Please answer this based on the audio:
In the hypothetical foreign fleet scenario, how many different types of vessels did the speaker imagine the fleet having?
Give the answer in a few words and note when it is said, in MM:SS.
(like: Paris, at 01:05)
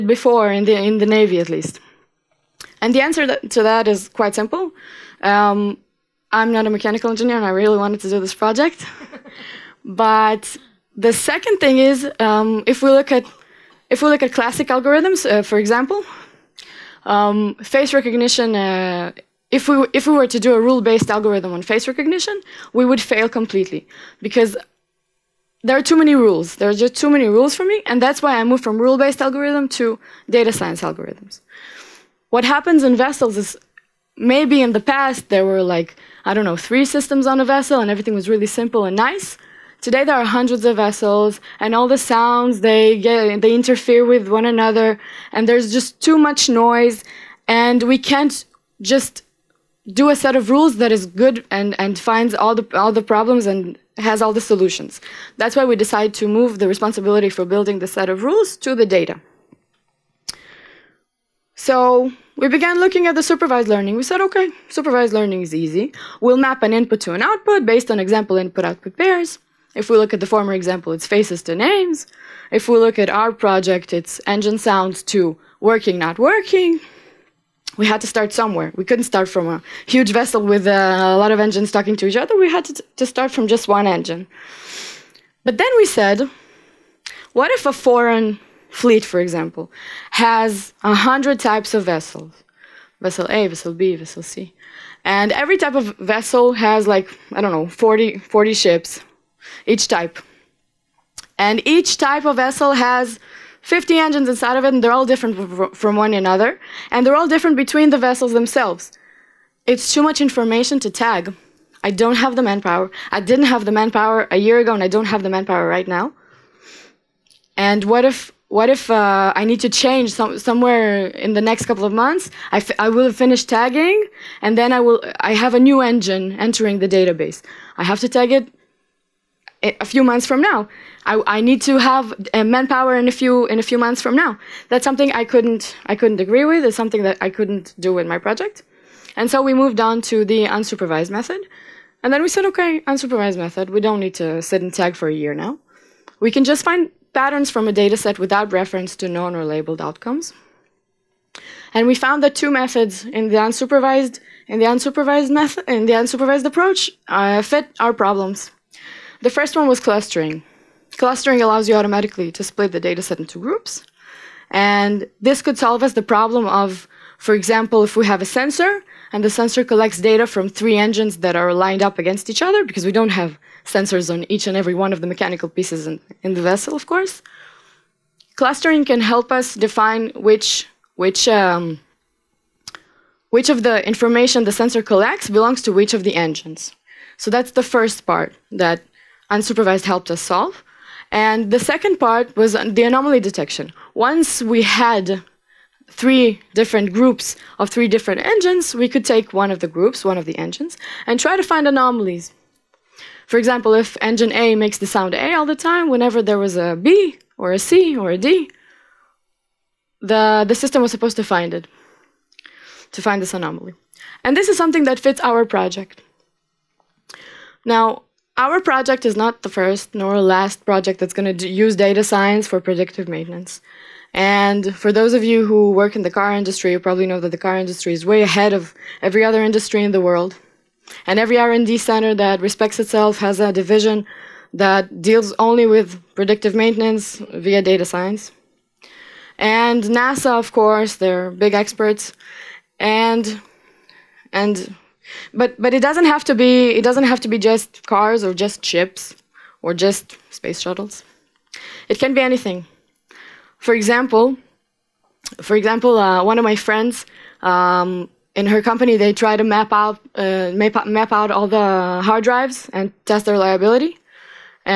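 100, at 01:30.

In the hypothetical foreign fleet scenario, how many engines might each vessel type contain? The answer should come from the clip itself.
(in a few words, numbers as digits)
50.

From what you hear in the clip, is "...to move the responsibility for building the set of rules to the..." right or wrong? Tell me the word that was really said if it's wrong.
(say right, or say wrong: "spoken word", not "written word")
right.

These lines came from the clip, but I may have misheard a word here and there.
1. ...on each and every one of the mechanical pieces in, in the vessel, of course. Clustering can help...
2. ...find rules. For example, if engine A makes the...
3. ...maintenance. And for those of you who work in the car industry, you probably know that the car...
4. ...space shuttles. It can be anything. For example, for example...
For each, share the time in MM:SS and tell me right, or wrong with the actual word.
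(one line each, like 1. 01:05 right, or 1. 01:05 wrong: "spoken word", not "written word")
1. 02:54 right
2. 03:21 wrong: "anomalies", not "rules"
3. 03:43 right
4. 04:10 right.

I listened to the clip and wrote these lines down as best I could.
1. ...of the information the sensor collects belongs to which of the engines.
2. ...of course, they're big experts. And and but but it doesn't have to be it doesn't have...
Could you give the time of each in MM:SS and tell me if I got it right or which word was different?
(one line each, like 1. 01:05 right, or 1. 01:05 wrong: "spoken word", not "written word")
1. 03:03 right
2. 04:00 right.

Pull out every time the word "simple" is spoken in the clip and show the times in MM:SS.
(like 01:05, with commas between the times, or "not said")
00:04, 00:38.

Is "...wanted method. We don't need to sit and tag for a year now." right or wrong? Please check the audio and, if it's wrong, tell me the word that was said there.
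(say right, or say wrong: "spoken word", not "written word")
wrong: "unsupervised", not "wanted".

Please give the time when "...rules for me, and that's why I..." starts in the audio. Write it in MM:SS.
00:27.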